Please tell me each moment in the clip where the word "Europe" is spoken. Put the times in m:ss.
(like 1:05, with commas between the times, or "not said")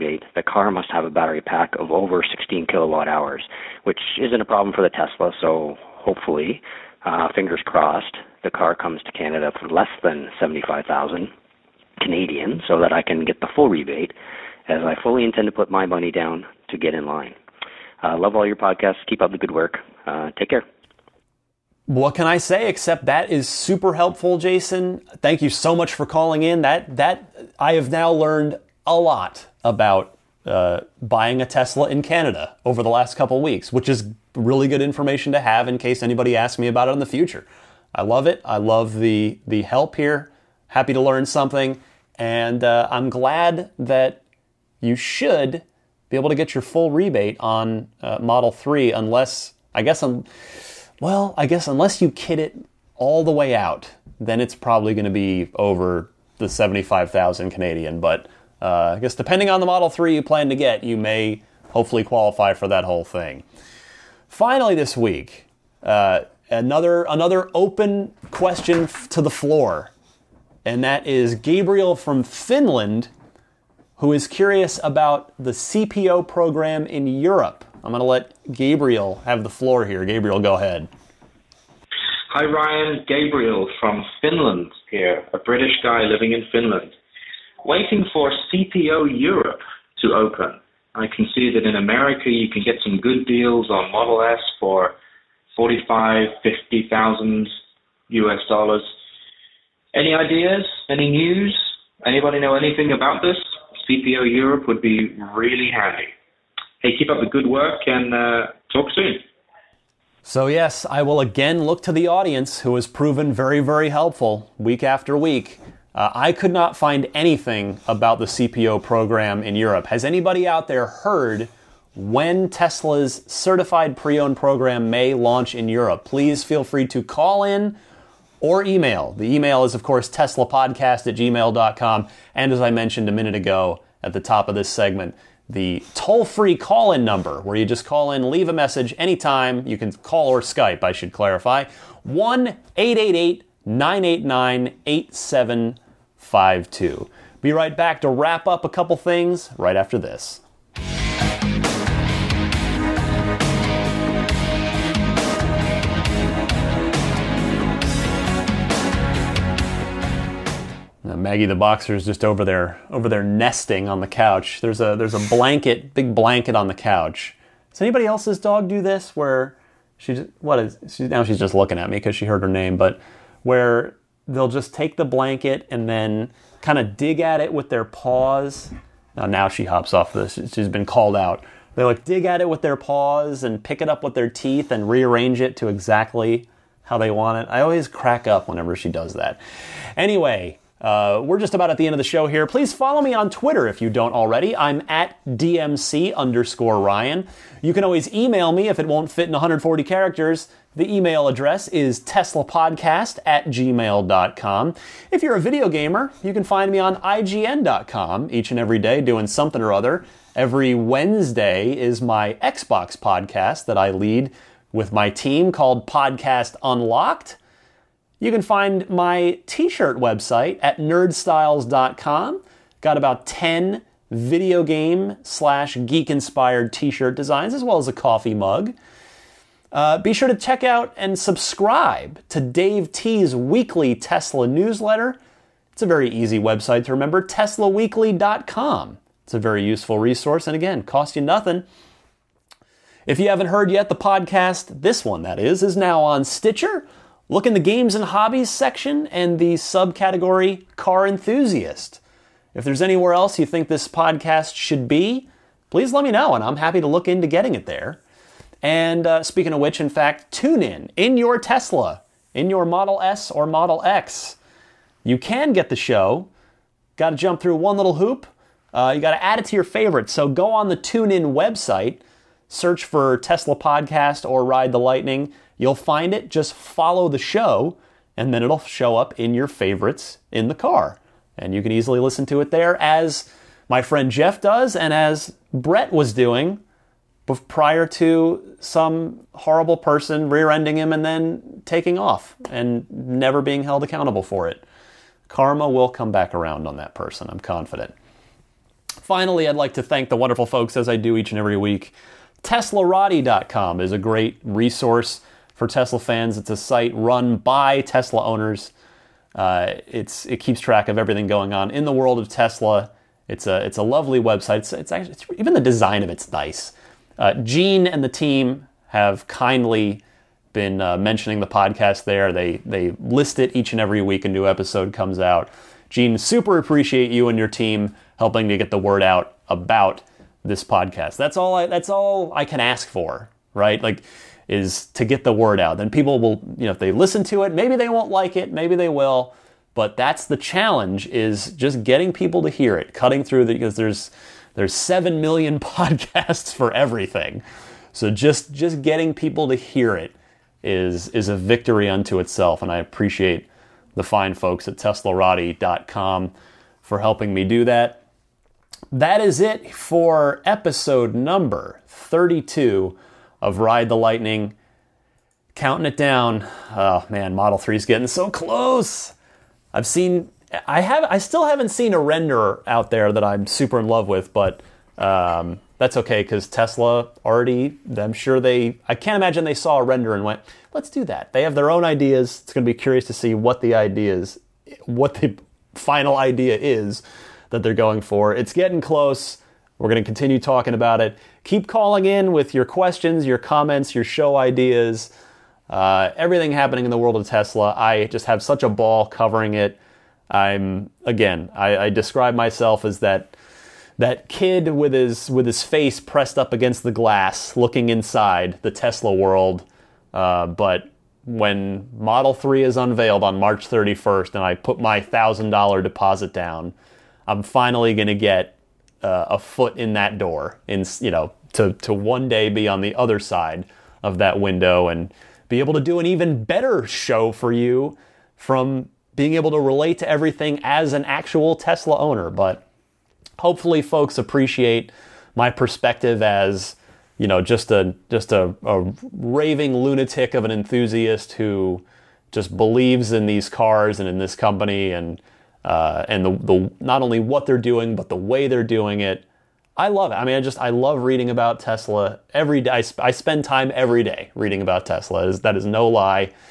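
1:17, 1:29, 1:44, 1:59, 2:05.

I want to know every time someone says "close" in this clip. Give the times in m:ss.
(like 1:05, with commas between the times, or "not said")
6:08, 6:28.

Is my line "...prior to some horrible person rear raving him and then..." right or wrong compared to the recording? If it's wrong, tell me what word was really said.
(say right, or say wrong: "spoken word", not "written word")
wrong: "ending", not "raving".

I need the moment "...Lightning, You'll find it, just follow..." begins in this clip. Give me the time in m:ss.
4:34.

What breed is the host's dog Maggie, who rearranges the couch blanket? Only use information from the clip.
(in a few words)
Boxer.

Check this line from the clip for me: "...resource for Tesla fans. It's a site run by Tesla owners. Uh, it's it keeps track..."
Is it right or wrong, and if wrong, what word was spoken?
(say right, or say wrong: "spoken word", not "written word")
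right.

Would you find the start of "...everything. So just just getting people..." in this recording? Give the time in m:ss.
5:46.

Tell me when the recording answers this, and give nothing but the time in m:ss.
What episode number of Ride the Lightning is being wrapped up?
6:01.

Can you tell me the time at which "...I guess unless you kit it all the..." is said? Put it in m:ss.
0:51.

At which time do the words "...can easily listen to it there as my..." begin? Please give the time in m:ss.
4:41.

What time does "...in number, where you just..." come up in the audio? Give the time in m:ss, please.
2:16.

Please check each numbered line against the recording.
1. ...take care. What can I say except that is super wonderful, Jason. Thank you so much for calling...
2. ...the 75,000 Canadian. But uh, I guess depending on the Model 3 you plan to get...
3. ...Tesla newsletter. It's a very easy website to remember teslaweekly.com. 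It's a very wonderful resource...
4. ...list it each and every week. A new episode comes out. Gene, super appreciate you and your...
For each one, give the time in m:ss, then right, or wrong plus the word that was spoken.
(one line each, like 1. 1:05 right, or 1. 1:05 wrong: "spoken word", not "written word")
1. 0:20 wrong: "helpful", not "wonderful"
2. 0:56 right
3. 3:53 wrong: "useful", not "wonderful"
4. 5:23 right.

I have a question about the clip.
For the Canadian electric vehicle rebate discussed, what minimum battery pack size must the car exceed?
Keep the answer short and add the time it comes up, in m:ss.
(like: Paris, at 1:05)
16 kilowatt hours, at 0:02.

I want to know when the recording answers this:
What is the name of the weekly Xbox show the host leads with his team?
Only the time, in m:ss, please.
3:35.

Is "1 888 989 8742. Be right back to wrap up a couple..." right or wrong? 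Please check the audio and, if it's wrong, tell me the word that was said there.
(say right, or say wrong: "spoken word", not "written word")
wrong: "8752", not "8742".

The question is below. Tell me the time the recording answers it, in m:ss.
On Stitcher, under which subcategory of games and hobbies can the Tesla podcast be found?
4:10.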